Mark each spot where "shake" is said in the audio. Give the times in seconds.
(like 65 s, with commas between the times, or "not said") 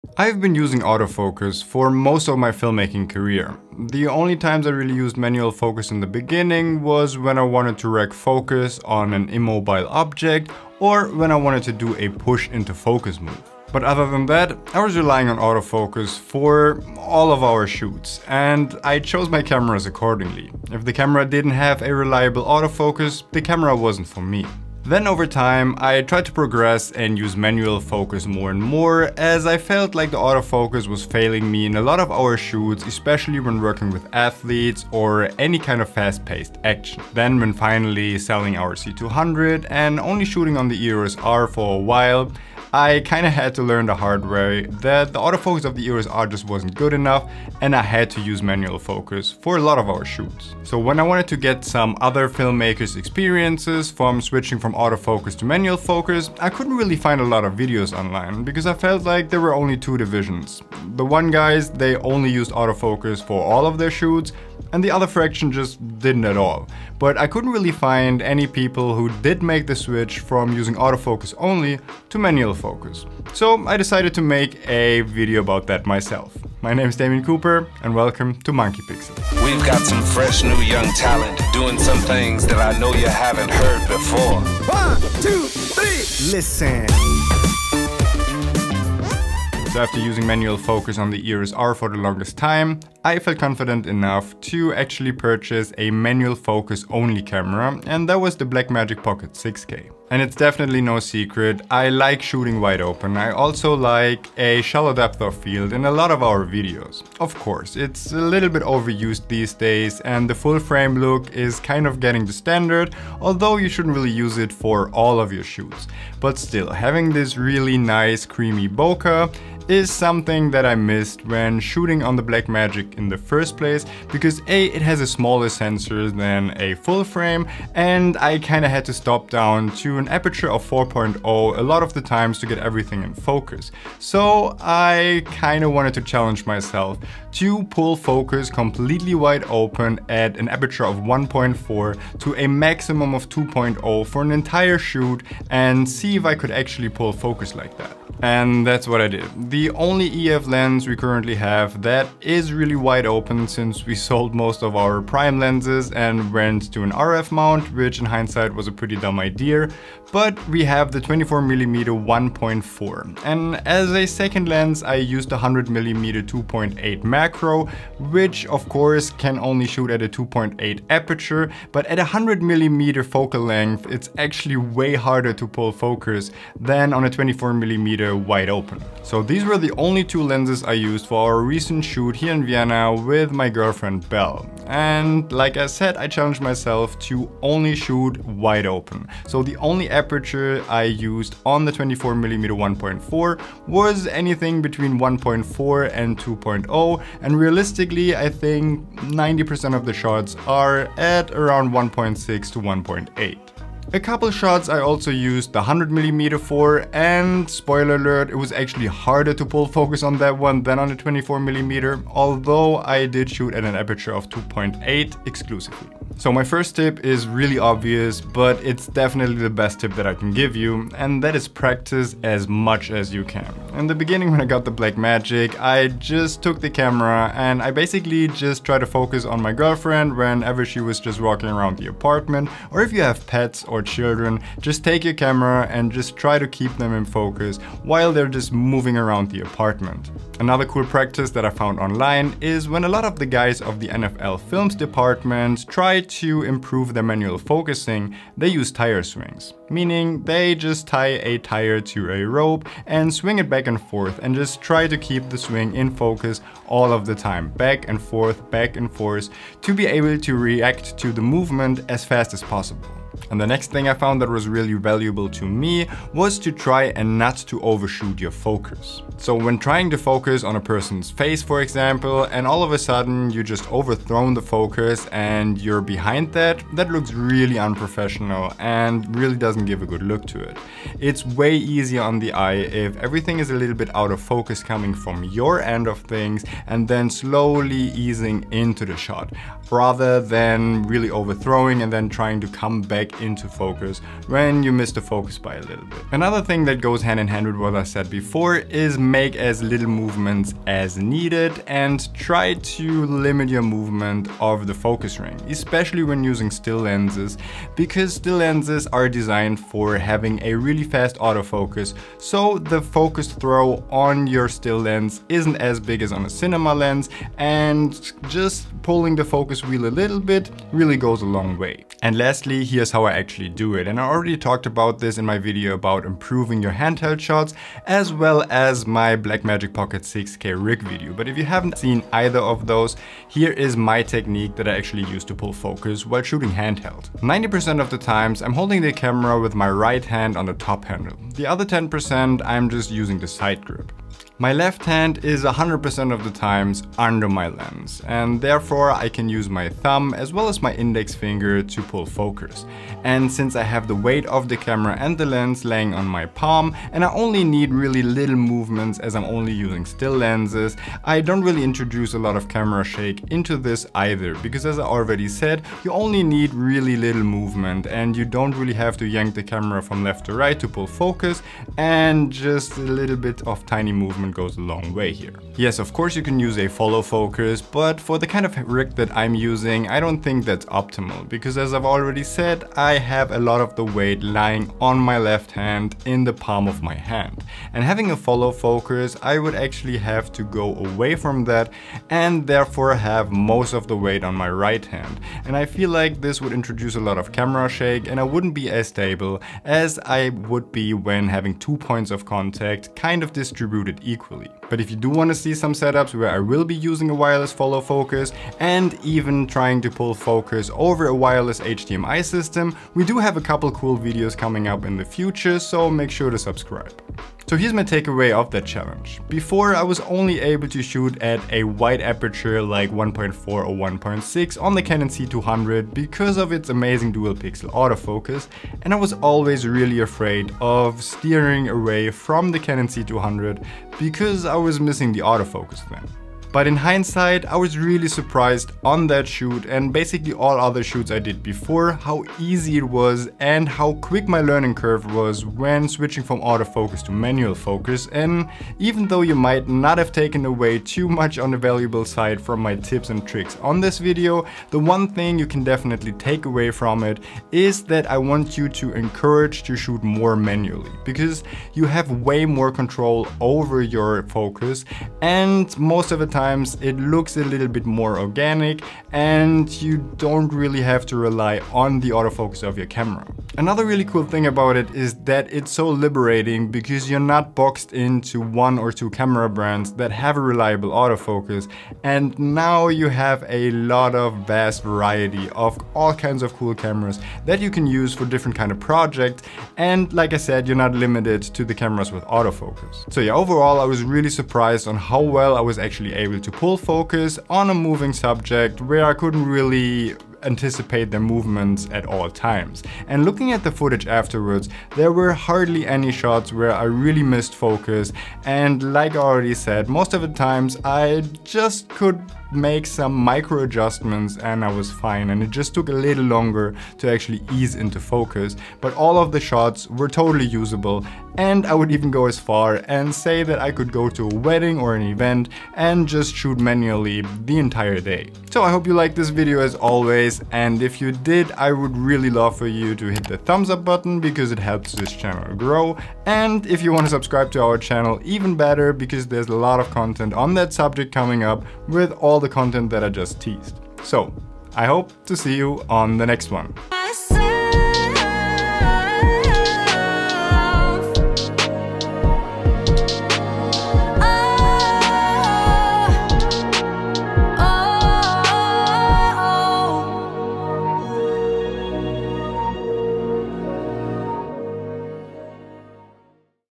362 s, 397 s.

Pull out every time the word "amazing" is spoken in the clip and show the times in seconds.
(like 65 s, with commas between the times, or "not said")
426 s.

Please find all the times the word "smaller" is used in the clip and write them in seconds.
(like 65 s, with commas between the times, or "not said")
125 s.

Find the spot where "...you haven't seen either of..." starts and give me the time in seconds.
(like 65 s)
331 s.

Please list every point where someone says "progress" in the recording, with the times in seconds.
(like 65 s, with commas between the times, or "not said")
26 s.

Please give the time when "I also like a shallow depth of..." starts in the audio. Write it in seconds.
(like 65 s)
103 s.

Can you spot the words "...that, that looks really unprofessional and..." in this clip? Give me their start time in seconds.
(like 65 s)
276 s.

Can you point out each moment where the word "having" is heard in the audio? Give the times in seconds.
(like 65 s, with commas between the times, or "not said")
116 s, 309 s, 387 s, 401 s.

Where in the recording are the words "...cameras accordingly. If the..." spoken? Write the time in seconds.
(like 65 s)
19 s.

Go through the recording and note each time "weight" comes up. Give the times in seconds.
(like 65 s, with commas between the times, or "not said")
353 s, 383 s, 393 s.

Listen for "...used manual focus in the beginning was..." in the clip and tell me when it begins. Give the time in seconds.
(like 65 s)
4 s.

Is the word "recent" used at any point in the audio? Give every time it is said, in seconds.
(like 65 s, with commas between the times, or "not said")
181 s.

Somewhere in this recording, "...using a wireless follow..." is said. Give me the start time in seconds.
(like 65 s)
406 s.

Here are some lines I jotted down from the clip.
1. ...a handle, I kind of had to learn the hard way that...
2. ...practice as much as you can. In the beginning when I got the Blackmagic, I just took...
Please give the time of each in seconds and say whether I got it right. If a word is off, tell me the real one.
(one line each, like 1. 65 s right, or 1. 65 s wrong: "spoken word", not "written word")
1. 41 s wrong: "while", not "handle"
2. 221 s right.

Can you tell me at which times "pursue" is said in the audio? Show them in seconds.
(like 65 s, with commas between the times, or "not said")
not said.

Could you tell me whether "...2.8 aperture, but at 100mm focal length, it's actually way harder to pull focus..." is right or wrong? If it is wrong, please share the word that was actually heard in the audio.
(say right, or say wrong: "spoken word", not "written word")
right.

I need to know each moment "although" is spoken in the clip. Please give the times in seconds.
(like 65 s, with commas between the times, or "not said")
113 s, 212 s.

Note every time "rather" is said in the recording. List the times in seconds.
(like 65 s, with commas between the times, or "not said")
289 s.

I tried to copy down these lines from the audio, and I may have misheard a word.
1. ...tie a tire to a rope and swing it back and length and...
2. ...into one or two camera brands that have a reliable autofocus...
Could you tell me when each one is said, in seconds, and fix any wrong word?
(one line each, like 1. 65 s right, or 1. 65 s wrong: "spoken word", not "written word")
1. 250 s wrong: "forth", not "length"
2. 477 s right.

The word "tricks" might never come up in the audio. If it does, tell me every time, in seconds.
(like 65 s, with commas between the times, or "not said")
453 s.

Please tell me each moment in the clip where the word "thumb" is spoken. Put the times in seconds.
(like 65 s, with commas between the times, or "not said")
349 s, 533 s.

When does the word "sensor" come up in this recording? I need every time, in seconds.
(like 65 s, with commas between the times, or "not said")
125 s.